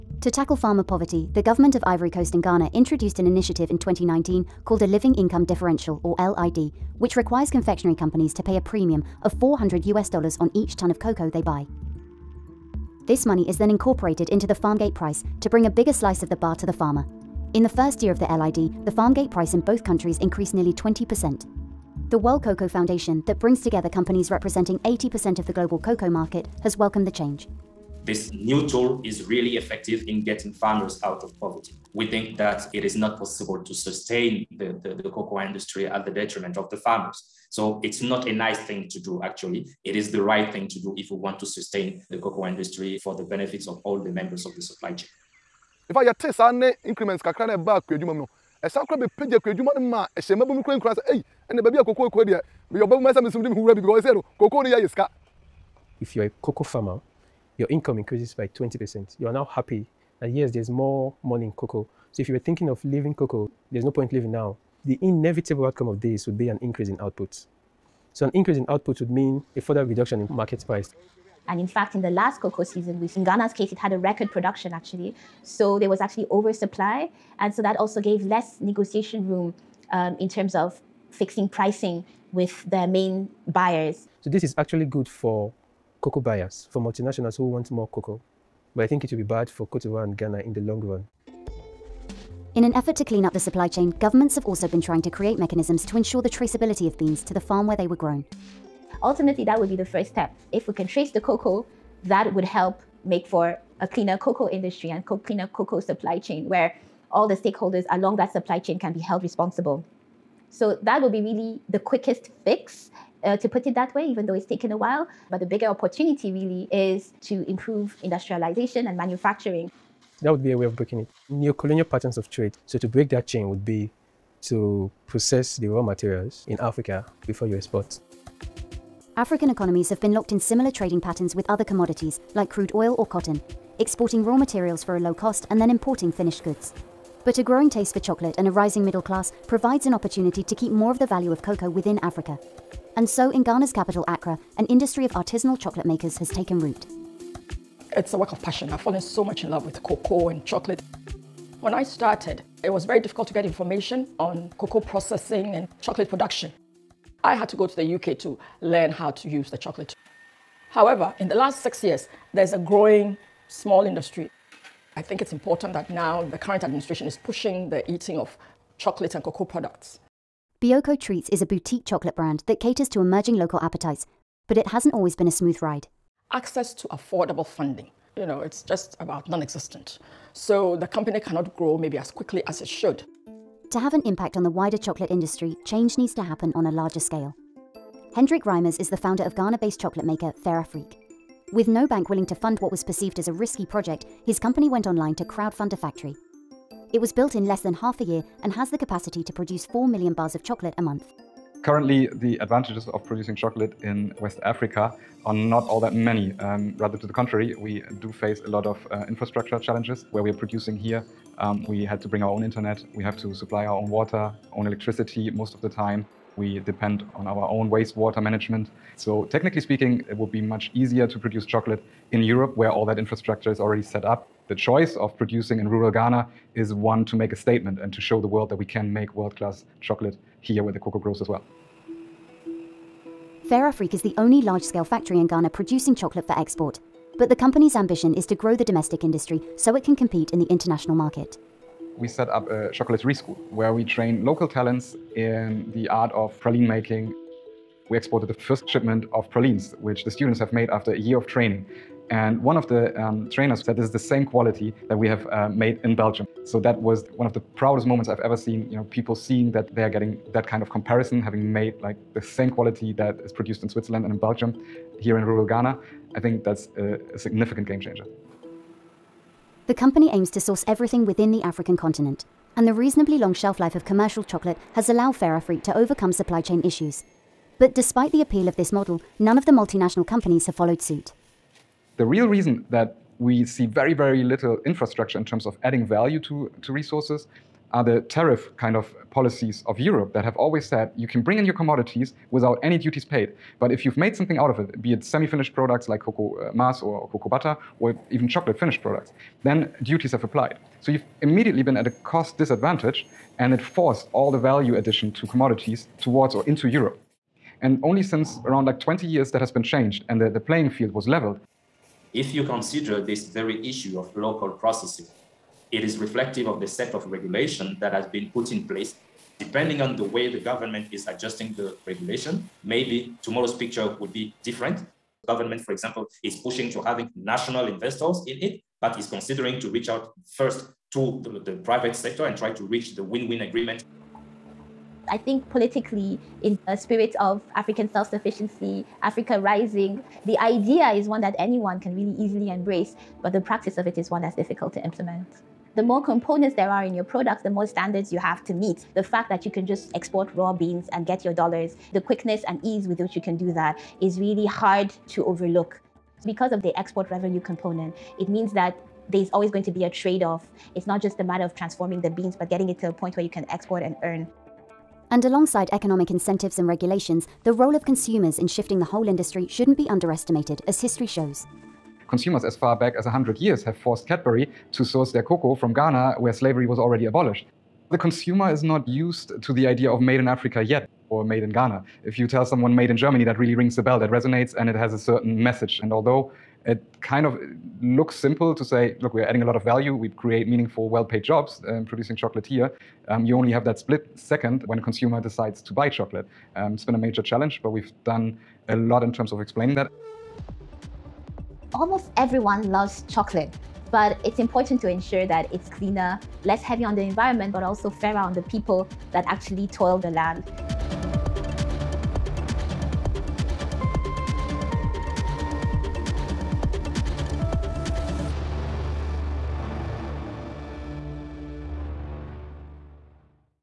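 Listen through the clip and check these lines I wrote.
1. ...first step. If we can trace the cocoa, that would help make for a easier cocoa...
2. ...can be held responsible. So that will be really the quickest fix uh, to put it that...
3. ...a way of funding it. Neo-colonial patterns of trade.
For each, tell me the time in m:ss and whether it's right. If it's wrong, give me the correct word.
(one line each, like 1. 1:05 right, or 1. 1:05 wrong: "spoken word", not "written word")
1. 1:39 wrong: "cleaner", not "easier"
2. 1:48 right
3. 2:00 wrong: "breaking", not "funding".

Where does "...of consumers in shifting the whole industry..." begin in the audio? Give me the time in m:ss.
6:07.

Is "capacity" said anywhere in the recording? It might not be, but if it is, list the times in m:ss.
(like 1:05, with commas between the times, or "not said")
3:18.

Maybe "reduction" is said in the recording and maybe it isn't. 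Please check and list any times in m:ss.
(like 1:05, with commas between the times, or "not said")
1:09.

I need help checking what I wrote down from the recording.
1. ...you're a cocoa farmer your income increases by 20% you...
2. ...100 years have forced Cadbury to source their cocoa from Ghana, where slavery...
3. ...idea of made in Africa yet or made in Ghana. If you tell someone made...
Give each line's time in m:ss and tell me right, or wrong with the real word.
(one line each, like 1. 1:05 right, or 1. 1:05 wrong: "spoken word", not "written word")
1. 0:56 right
2. 6:13 right
3. 6:19 right.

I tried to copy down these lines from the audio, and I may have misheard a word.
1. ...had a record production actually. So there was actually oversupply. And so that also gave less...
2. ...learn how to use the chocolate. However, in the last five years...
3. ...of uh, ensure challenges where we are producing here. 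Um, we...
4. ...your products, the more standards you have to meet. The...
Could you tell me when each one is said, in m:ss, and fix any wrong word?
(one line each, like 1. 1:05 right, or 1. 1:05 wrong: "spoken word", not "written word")
1. 1:13 right
2. 2:38 wrong: "six", not "five"
3. 3:28 wrong: "infrastructure", not "ensure"
4. 5:46 right.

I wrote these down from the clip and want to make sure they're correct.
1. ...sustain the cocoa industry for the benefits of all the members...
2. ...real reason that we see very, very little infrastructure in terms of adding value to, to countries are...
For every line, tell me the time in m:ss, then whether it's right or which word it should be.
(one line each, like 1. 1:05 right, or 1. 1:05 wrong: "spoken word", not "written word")
1. 0:41 right
2. 4:42 wrong: "resources", not "countries".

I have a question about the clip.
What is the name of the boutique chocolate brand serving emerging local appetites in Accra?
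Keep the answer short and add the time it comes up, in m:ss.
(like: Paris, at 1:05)
Bioko Treats, at 2:50.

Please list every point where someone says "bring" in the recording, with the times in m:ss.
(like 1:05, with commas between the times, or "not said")
0:15, 0:23, 3:32, 4:51.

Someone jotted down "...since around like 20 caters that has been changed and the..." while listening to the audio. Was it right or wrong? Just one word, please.
wrong.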